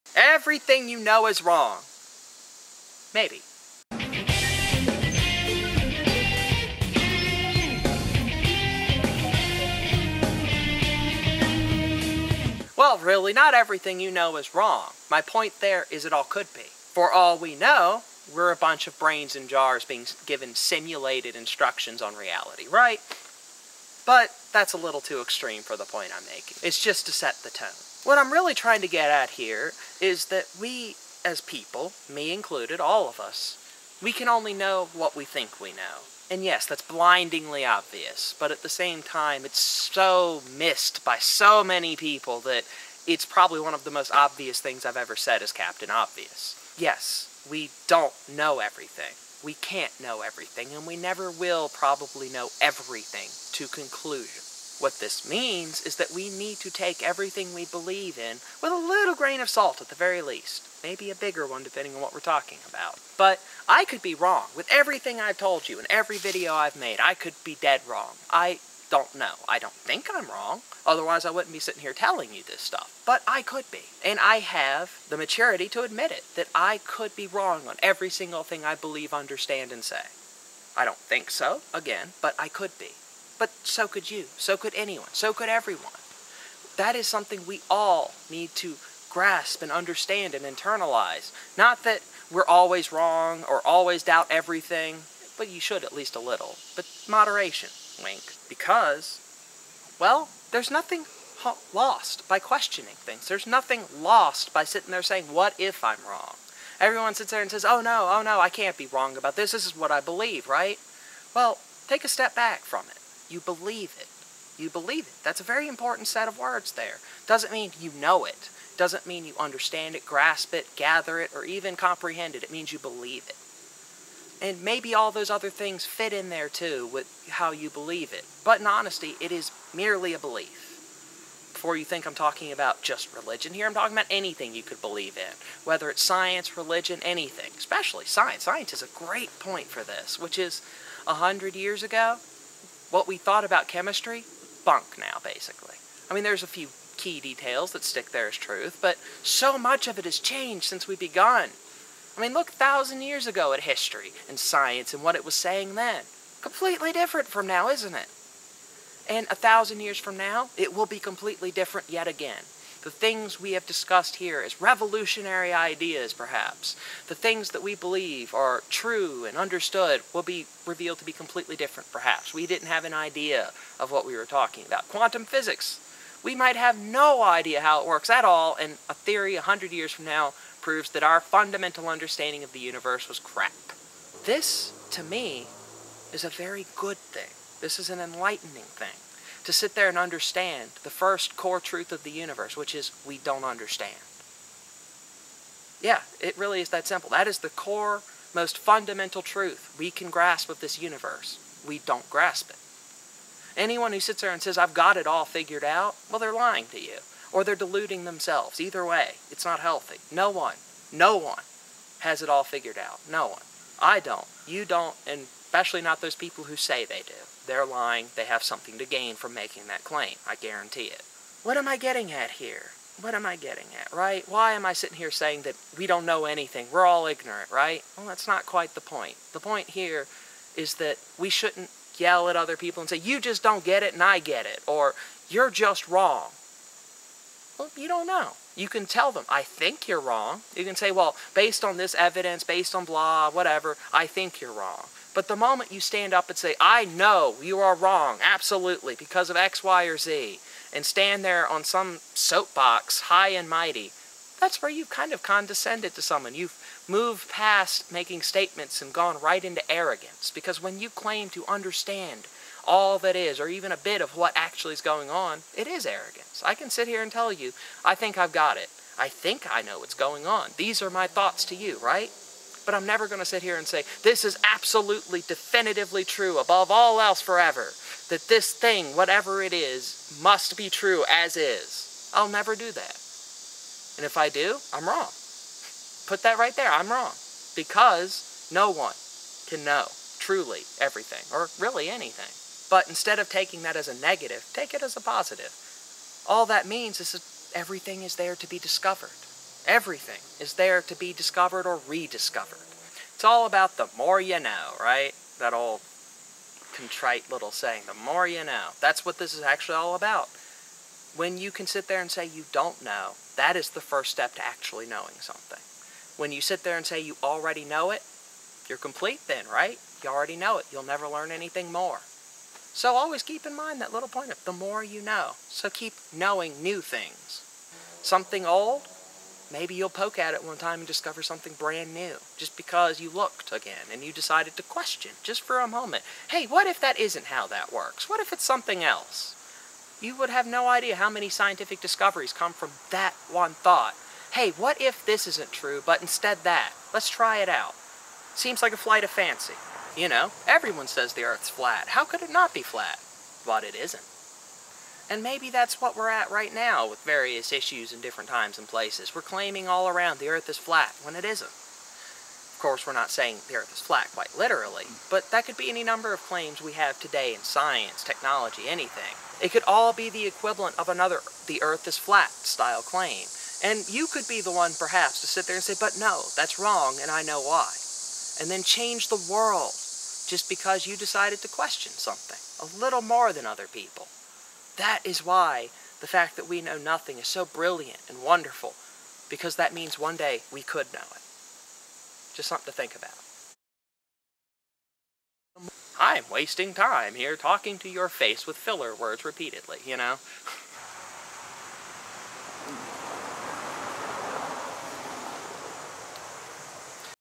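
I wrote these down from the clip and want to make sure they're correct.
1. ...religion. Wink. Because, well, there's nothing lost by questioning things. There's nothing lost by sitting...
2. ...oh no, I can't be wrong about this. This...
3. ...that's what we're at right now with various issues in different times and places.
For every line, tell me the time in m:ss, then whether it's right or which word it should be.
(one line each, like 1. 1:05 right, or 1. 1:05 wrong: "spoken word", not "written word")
1. 1:37 wrong: "moderation", not "religion"
2. 1:48 right
3. 5:55 right.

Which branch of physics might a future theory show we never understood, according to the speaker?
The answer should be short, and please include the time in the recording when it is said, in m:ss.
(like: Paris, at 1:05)
Quantum physics, at 2:54.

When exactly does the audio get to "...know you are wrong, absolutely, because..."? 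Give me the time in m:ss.
4:06.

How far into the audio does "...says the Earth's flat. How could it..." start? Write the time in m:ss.
5:50.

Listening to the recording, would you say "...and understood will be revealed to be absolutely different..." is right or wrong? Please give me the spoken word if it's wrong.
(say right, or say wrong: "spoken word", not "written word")
wrong: "completely", not "absolutely".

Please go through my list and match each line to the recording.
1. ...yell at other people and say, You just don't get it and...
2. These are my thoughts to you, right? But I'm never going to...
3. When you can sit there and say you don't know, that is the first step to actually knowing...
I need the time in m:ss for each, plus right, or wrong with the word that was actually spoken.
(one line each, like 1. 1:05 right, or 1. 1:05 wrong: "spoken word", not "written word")
1. 3:51 right
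2. 4:30 right
3. 5:11 right.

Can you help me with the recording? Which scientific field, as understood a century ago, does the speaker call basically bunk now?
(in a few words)
chemistry.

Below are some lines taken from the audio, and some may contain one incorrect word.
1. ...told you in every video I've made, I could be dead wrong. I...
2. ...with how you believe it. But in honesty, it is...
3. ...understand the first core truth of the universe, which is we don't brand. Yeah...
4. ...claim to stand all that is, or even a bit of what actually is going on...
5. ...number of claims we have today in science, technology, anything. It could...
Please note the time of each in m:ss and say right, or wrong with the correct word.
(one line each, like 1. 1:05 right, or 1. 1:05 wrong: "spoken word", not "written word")
1. 1:05 right
2. 2:06 right
3. 3:09 wrong: "understand", not "brand"
4. 4:20 wrong: "understand", not "stand"
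5. 6:05 right.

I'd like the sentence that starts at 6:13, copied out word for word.
And you could be the one, perhaps, to sit there and say, but no, that's wrong, and I know why.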